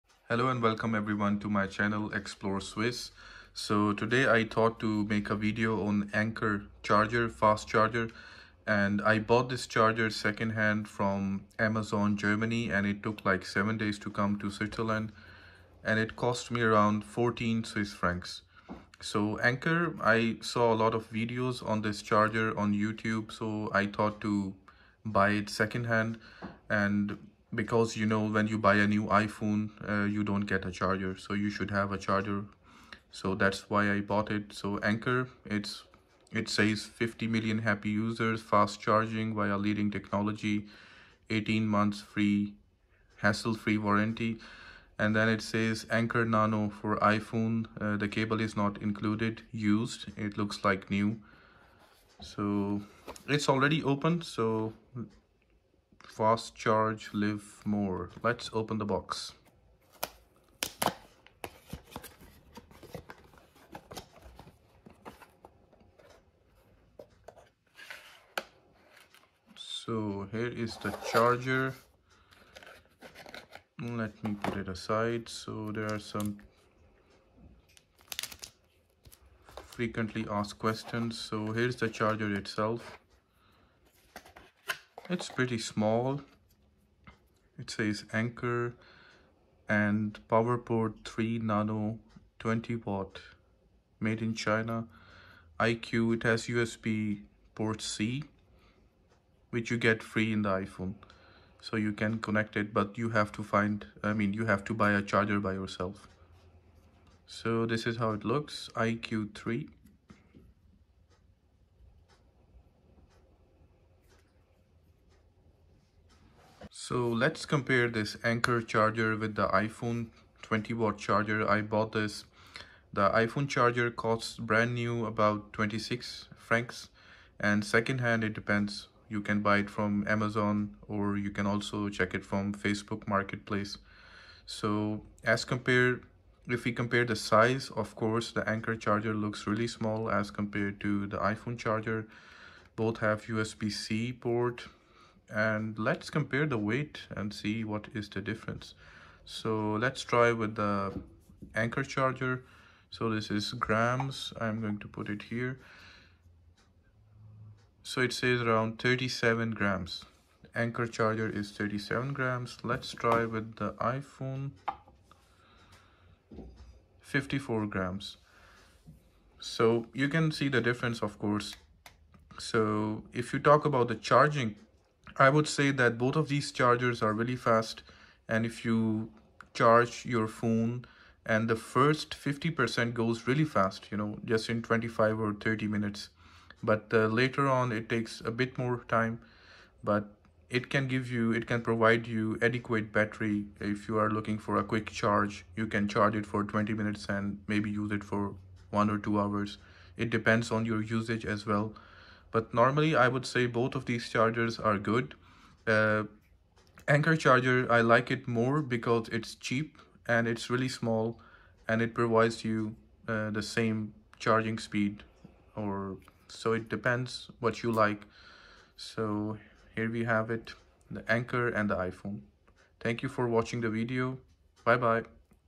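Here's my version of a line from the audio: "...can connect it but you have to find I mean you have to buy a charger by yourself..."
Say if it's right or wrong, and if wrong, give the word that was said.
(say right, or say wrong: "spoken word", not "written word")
right.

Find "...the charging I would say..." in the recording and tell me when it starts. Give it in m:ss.
2:53.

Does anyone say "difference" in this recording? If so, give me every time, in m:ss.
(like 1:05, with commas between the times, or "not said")
2:28, 2:50.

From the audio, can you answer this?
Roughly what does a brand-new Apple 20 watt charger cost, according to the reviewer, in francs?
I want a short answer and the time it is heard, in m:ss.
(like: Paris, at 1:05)
26, at 2:05.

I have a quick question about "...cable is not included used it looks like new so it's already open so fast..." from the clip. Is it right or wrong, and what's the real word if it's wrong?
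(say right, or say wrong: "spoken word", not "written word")
right.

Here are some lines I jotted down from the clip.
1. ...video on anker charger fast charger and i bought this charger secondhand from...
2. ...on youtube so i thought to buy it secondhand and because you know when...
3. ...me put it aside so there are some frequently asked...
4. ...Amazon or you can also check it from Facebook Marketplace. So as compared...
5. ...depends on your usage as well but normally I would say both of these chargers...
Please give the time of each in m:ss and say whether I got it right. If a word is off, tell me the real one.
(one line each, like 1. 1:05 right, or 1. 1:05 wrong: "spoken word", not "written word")
1. 0:05 right
2. 0:22 right
3. 1:14 right
4. 2:10 right
5. 3:20 right.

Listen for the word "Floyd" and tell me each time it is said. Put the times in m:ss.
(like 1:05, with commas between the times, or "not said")
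not said.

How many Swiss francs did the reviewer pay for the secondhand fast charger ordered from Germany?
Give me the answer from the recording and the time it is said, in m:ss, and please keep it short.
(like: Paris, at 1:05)
14, at 0:17.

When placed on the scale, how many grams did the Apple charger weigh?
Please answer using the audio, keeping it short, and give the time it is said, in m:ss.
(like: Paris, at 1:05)
54 grams, at 2:46.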